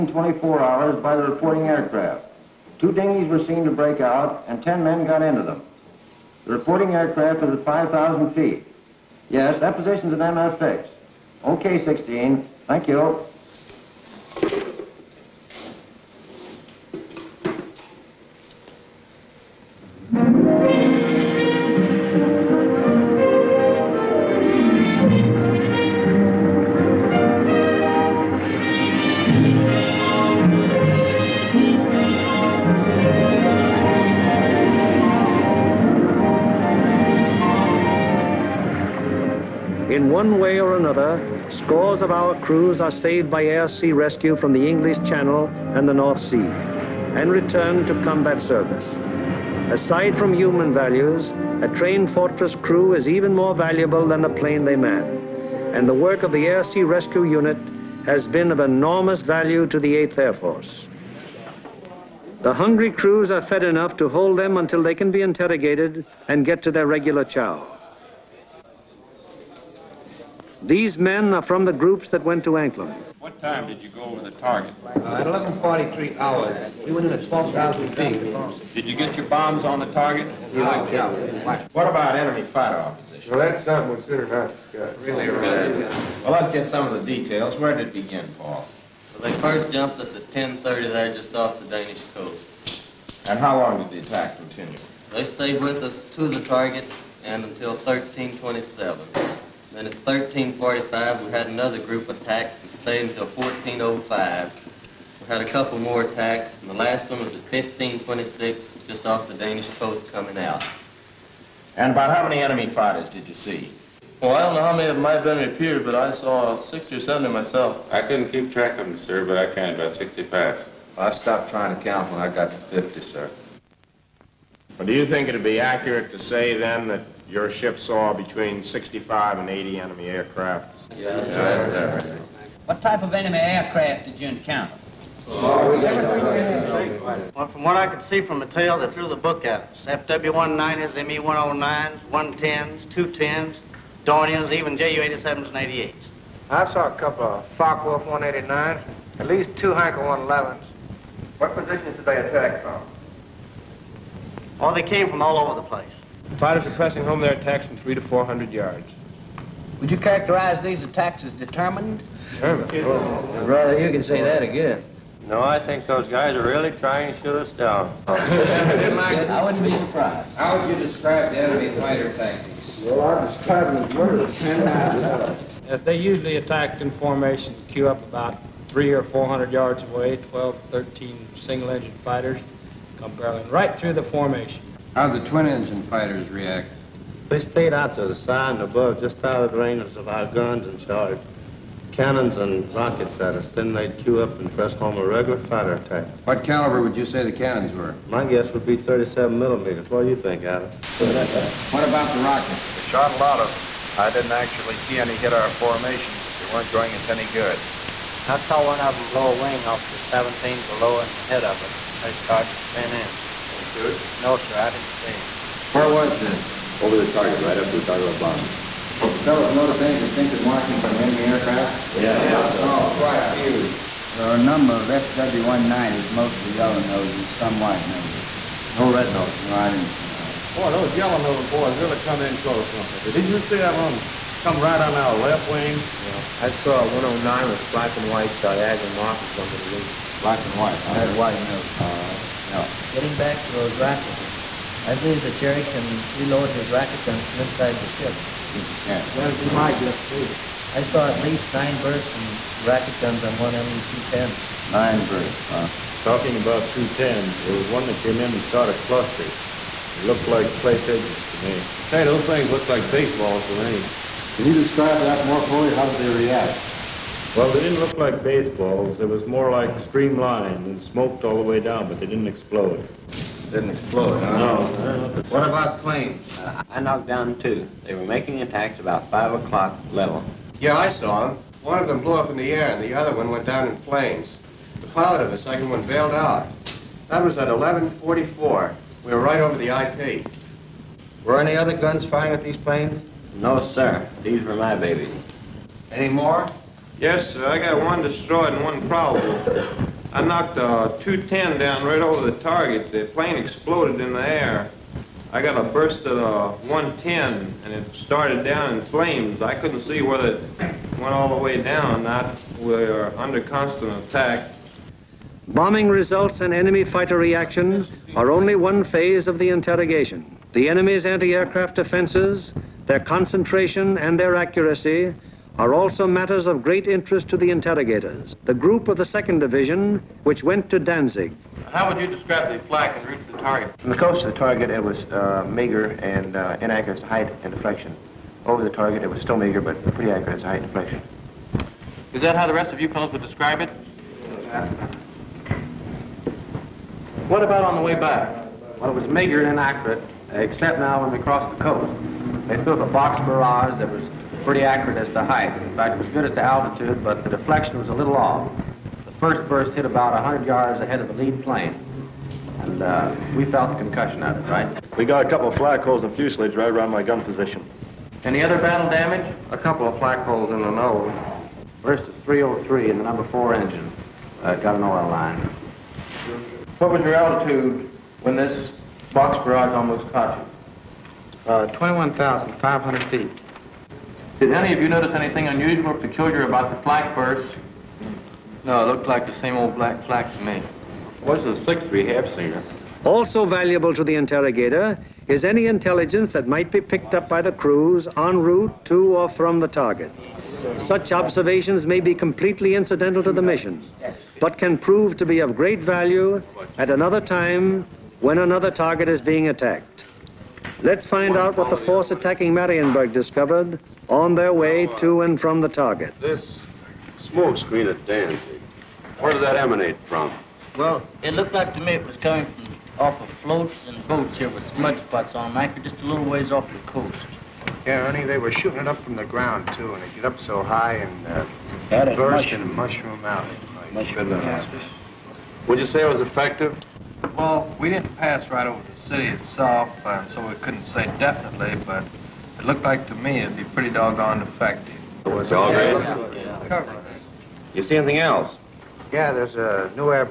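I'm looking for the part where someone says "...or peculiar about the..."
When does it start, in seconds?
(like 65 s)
385 s.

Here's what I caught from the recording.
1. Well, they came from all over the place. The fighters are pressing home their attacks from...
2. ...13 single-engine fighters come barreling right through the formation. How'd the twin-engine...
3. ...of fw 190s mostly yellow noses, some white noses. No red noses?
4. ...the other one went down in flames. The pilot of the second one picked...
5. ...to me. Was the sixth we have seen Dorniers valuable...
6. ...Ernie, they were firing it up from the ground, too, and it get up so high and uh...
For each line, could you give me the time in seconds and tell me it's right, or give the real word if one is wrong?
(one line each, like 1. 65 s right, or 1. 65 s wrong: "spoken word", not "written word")
1. 154 s right
2. 180 s right
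3. 224 s right
4. 282 s wrong: "bailed", not "picked"
5. 390 s wrong: "Also", not "Dorniers"
6. 428 s wrong: "shooting", not "firing".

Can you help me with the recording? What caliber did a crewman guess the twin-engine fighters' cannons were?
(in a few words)
37 millimeters.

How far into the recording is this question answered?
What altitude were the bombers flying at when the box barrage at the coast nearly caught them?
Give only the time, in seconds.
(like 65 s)
381 s.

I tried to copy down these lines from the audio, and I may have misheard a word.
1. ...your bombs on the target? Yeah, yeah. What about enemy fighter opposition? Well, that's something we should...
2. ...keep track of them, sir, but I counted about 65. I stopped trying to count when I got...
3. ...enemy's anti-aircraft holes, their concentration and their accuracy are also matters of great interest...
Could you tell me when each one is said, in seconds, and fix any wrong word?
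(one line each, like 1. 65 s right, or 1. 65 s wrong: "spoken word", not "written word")
1. 79 s right
2. 118 s right
3. 320 s wrong: "defenses", not "holes".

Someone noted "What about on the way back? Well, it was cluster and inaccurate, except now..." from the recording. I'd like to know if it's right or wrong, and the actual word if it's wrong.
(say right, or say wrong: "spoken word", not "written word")
wrong: "meager", not "cluster".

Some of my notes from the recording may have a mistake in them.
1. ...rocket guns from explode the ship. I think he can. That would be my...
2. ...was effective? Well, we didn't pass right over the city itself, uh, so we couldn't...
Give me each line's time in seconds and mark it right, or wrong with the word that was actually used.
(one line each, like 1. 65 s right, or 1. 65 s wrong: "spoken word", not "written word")
1. 246 s wrong: "inside", not "explode"
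2. 436 s right.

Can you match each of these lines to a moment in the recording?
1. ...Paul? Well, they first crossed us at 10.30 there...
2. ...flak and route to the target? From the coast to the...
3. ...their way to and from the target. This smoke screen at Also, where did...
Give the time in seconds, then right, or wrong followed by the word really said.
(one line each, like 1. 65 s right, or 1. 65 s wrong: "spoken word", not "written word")
1. 88 s wrong: "jumped", not "crossed"
2. 332 s right
3. 414 s wrong: "Danzig", not "Also".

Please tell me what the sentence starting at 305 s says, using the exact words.
I got a burst at a uh, 110, and it started down in flames.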